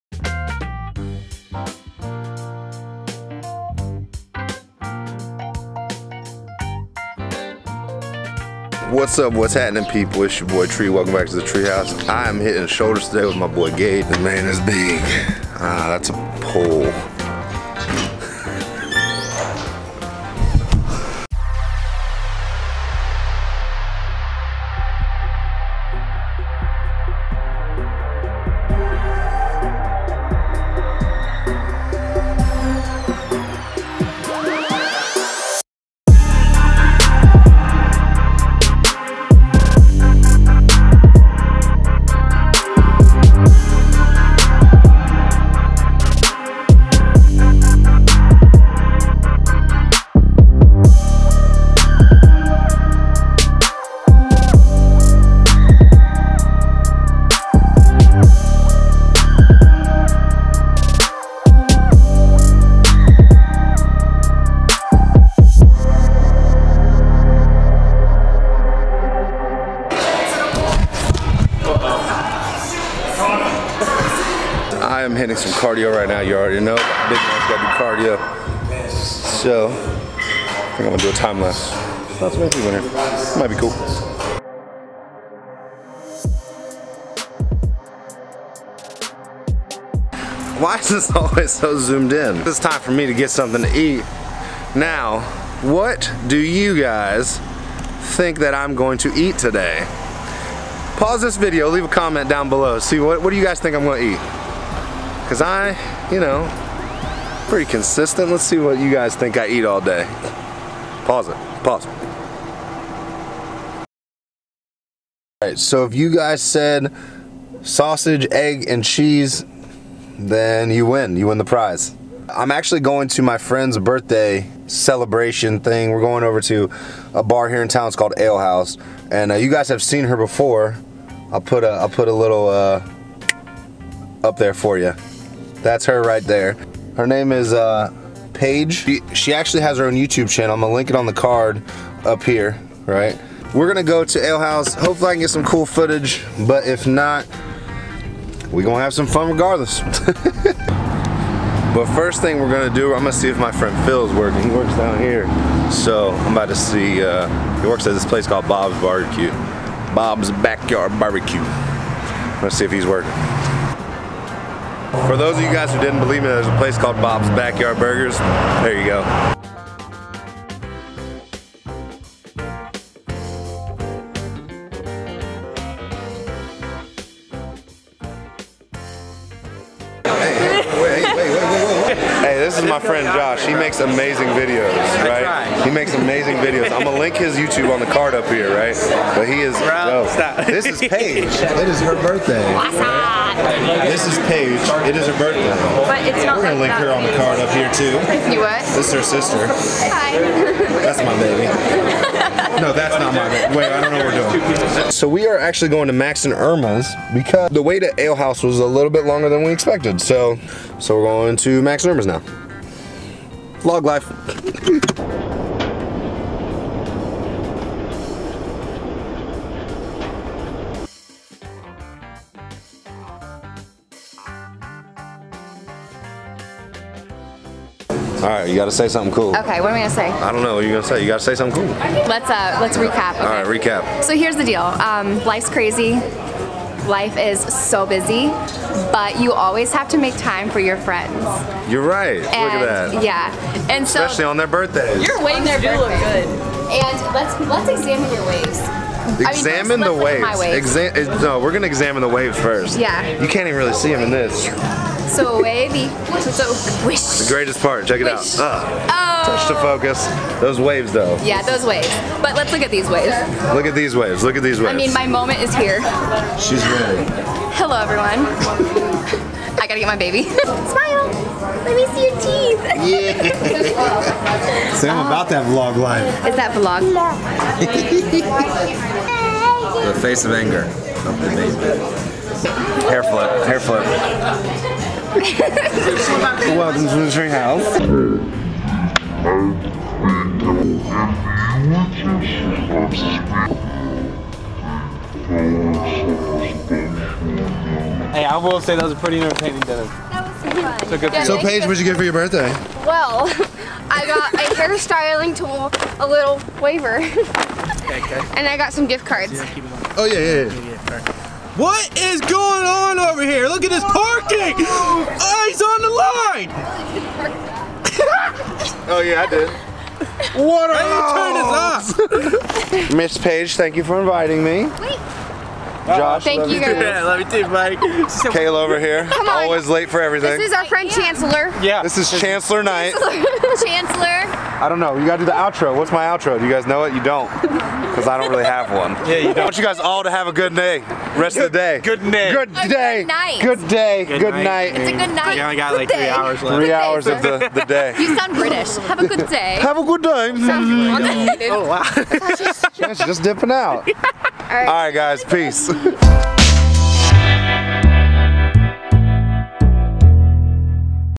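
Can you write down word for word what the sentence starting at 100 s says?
Pause this video, leave a comment down below.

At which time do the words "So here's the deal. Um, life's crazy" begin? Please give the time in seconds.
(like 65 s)
234 s.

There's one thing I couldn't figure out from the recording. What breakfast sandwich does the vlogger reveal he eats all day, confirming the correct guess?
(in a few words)
Sausage, egg, and cheese.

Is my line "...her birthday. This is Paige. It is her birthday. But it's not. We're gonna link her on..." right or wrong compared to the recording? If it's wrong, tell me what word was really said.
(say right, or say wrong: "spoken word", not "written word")
right.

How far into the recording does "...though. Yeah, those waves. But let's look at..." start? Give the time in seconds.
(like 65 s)
260 s.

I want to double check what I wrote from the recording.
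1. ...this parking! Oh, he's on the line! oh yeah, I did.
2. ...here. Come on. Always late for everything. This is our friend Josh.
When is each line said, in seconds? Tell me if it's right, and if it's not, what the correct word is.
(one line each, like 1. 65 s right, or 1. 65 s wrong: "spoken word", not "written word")
1. 313 s right
2. 328 s wrong: "Chancellor", not "Josh".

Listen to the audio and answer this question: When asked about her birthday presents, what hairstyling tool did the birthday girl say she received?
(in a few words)
A little waver.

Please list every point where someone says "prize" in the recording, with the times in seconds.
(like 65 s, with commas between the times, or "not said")
121 s.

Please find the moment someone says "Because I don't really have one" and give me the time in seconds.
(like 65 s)
337 s.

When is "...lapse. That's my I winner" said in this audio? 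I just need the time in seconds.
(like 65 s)
81 s.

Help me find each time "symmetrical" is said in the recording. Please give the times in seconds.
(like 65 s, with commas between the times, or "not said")
not said.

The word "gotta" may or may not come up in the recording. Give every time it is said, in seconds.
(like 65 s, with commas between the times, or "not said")
269 s, 335 s.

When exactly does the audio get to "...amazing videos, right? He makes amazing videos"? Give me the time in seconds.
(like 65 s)
183 s.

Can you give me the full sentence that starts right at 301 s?
So, so Paige, what did you get for your birthday?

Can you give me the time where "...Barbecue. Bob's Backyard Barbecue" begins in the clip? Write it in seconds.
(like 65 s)
158 s.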